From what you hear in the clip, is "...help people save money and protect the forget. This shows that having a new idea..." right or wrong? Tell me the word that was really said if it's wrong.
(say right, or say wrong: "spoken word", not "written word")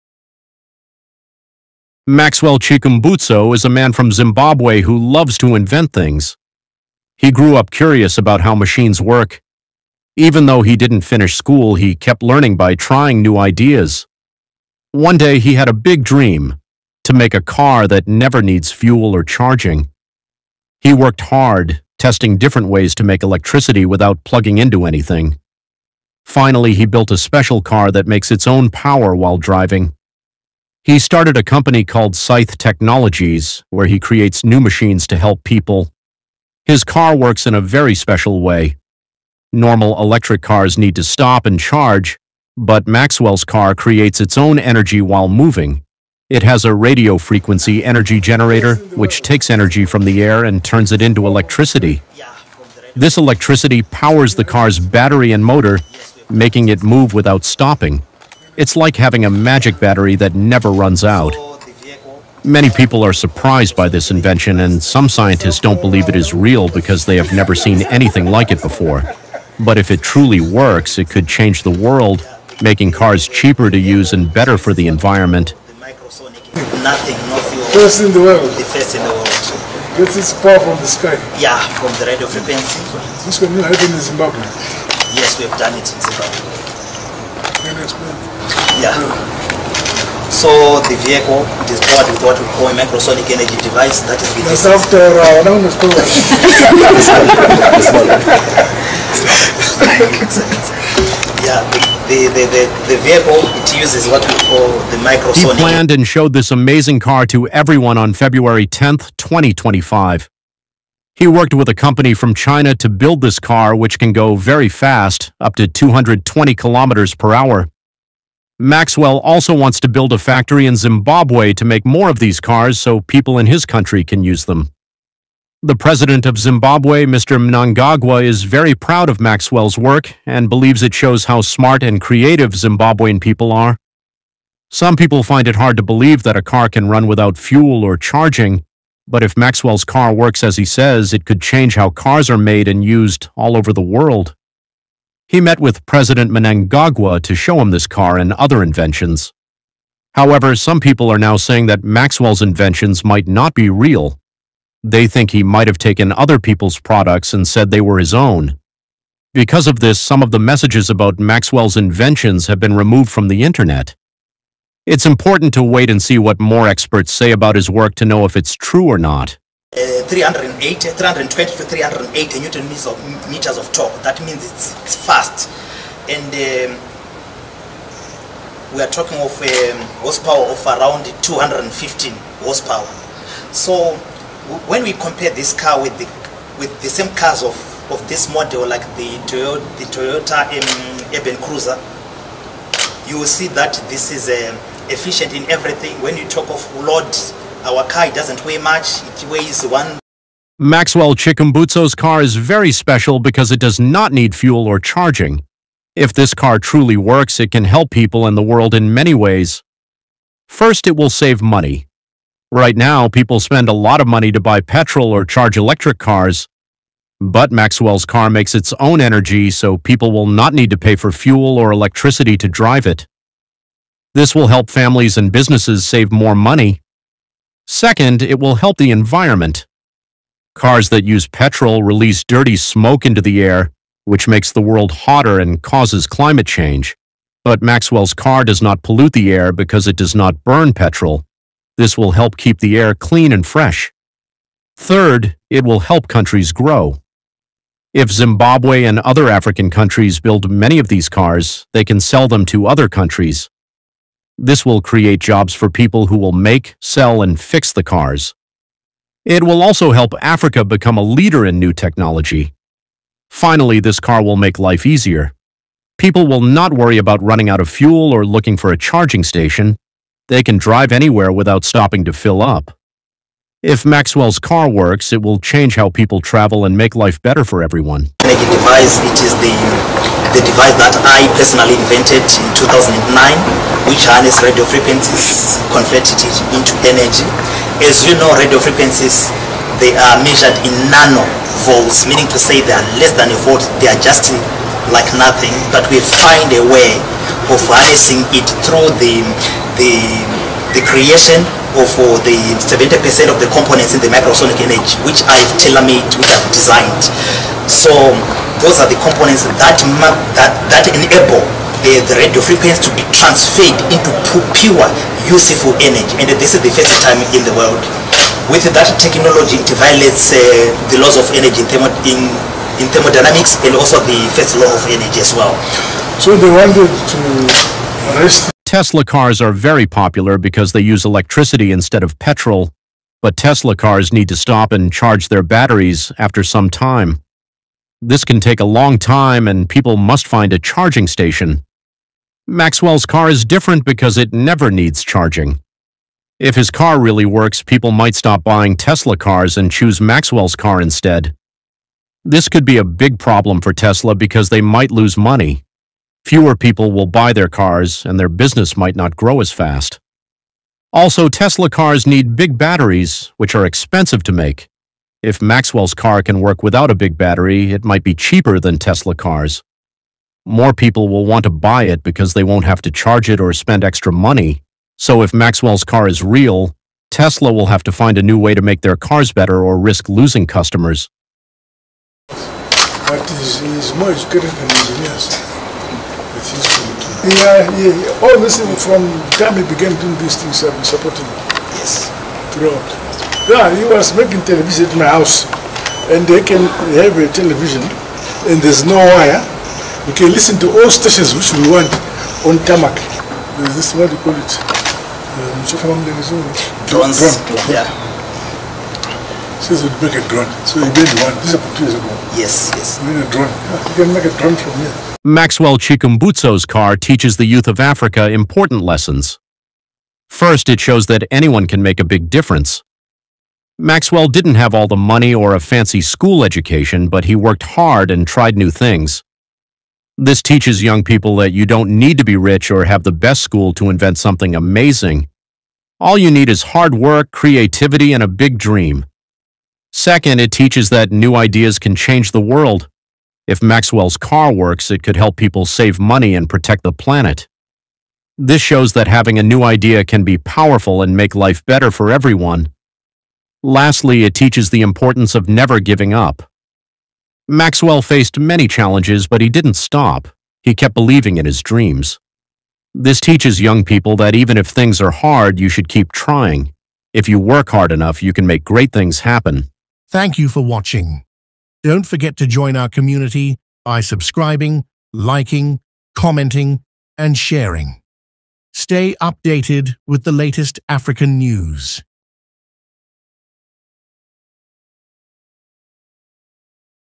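wrong: "planet", not "forget".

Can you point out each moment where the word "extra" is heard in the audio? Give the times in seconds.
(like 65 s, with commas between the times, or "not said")
373 s.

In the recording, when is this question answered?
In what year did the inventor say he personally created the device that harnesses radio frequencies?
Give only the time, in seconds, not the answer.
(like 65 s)
282 s.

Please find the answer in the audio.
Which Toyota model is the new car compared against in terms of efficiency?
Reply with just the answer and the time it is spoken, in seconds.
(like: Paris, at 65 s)
Urban Cruiser, at 191 s.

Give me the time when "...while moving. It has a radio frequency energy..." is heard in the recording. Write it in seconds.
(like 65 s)
45 s.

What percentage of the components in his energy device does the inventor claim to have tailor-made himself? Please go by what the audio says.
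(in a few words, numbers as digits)
70%.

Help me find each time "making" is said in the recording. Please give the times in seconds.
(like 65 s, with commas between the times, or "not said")
56 s, 72 s, 394 s.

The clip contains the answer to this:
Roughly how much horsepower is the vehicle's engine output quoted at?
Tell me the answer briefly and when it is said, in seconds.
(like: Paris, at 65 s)
215, at 181 s.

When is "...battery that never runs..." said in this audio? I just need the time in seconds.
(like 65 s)
59 s.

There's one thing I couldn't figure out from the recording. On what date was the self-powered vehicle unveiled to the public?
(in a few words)
February 10th, 2025.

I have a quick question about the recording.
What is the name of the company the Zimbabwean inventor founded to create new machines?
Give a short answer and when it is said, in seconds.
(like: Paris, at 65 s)
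Saith Technologies, at 32 s.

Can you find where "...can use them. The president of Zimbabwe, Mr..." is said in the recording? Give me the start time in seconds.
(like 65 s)
124 s.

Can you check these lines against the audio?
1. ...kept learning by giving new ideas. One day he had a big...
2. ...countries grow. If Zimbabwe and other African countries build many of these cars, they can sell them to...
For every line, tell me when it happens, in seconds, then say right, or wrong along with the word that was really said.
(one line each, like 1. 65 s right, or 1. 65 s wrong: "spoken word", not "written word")
1. 11 s wrong: "trying", not "giving"
2. 246 s right.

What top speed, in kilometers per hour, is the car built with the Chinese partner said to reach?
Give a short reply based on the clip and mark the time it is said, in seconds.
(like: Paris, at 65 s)
220, at 115 s.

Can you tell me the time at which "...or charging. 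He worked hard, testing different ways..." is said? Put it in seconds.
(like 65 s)
19 s.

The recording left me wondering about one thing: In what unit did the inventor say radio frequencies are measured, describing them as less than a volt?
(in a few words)
nano volts.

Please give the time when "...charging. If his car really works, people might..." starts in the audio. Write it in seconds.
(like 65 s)
345 s.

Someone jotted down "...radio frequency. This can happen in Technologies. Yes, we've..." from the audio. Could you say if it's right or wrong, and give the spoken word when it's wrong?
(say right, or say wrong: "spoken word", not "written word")
wrong: "Zimbabwe", not "Technologies".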